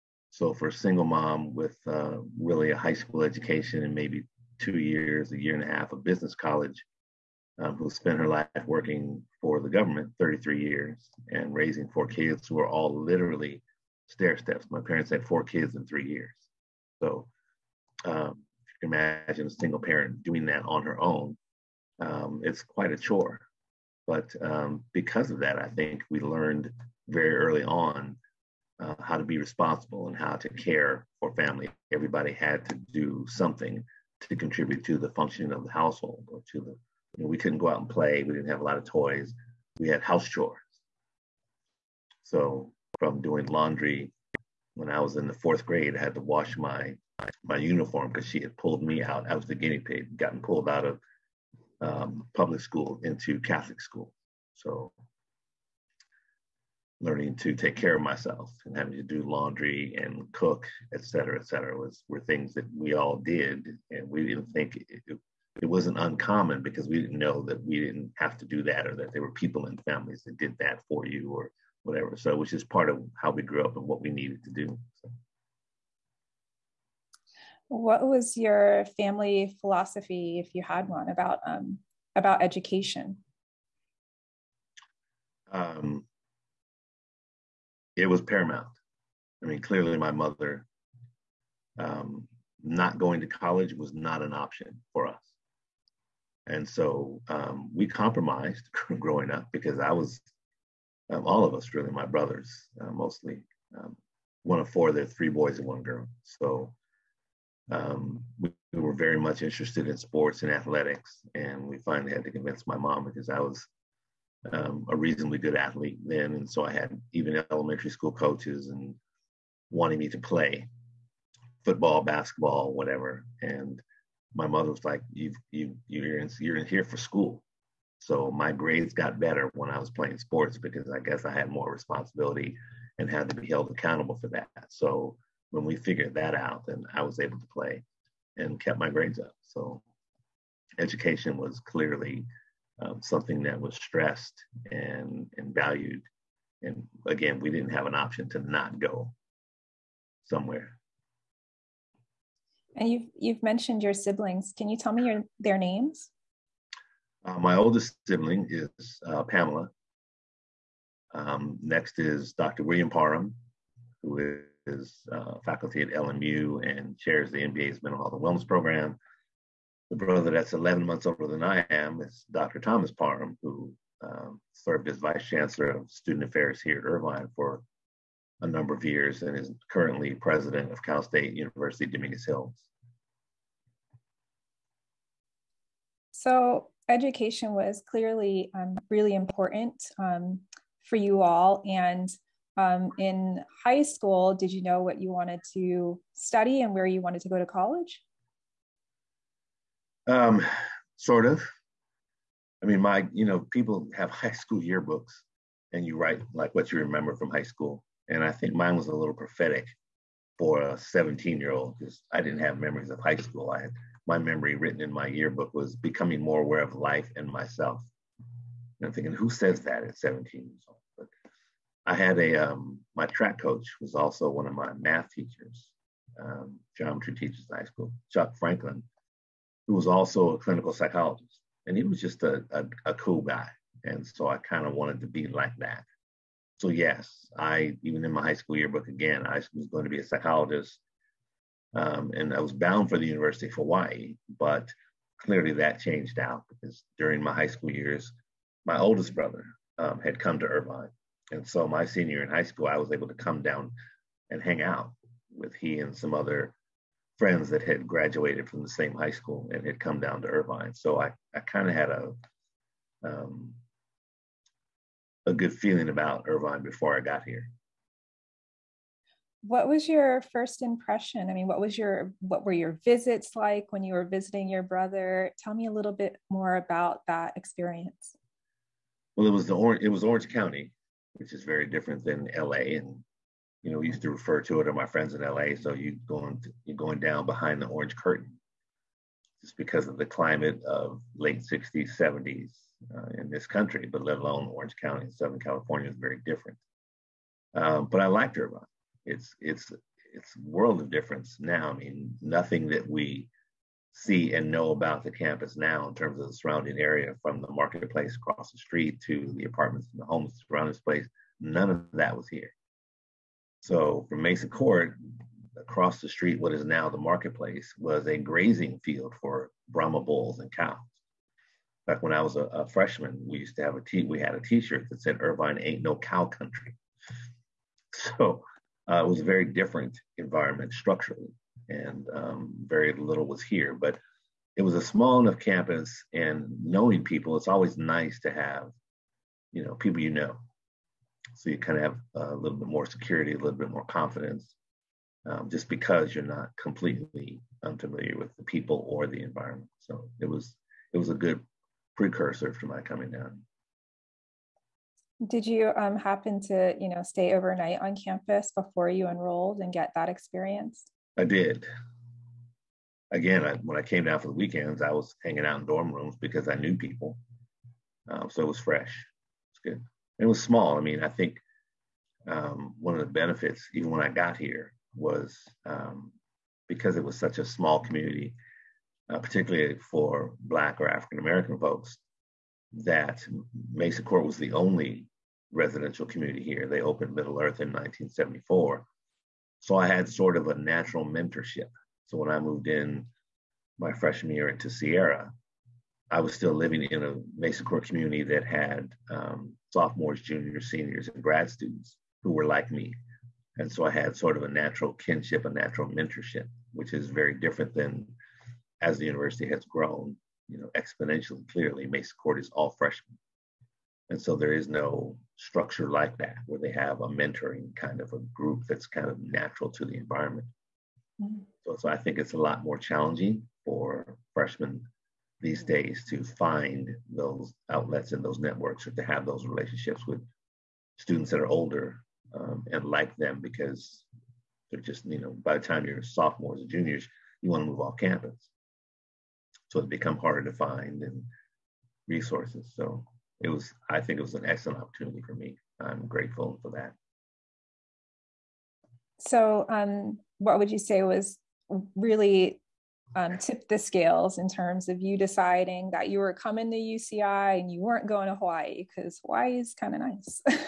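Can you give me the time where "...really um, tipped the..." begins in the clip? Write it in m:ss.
7:31.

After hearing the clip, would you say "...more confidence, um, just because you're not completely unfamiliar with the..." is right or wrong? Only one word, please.
right.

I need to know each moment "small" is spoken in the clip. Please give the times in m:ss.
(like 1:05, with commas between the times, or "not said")
5:34, 6:10, 6:17.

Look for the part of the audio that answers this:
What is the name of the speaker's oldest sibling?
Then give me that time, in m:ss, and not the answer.
2:39.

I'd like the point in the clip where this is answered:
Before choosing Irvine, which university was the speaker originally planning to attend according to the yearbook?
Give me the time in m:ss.
4:03.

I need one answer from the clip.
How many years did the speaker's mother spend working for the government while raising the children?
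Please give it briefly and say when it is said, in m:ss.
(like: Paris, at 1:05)
33, at 0:10.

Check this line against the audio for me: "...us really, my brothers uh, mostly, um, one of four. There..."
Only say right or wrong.
right.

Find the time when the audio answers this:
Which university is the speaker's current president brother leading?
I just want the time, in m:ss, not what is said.
3:00.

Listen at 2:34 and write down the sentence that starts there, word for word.
Can you tell me your, their names?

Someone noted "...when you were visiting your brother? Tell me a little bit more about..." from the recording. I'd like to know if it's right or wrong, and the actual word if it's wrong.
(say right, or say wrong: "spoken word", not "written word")
right.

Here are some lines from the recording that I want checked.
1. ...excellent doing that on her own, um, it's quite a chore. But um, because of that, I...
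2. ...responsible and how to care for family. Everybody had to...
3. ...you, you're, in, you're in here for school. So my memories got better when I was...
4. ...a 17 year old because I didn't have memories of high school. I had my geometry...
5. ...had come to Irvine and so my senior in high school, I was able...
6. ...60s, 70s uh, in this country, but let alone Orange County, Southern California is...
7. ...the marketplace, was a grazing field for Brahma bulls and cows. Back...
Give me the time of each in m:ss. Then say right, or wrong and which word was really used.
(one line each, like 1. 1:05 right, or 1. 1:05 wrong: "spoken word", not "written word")
1. 0:19 wrong: "parent", not "excellent"
2. 0:29 right
3. 2:05 wrong: "grades", not "memories"
4. 3:30 wrong: "memory", not "geometry"
5. 4:10 right
6. 4:51 right
7. 5:16 right.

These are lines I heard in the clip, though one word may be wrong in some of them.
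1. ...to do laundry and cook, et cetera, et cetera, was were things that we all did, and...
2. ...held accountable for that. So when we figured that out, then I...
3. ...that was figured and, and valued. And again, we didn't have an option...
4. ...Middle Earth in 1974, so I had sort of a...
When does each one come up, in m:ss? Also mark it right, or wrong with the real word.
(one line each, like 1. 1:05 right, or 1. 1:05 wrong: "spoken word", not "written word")
1. 0:58 right
2. 2:13 right
3. 2:23 wrong: "stressed", not "figured"
4. 6:27 right.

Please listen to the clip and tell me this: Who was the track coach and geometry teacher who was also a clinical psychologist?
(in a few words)
Chuck Franklin.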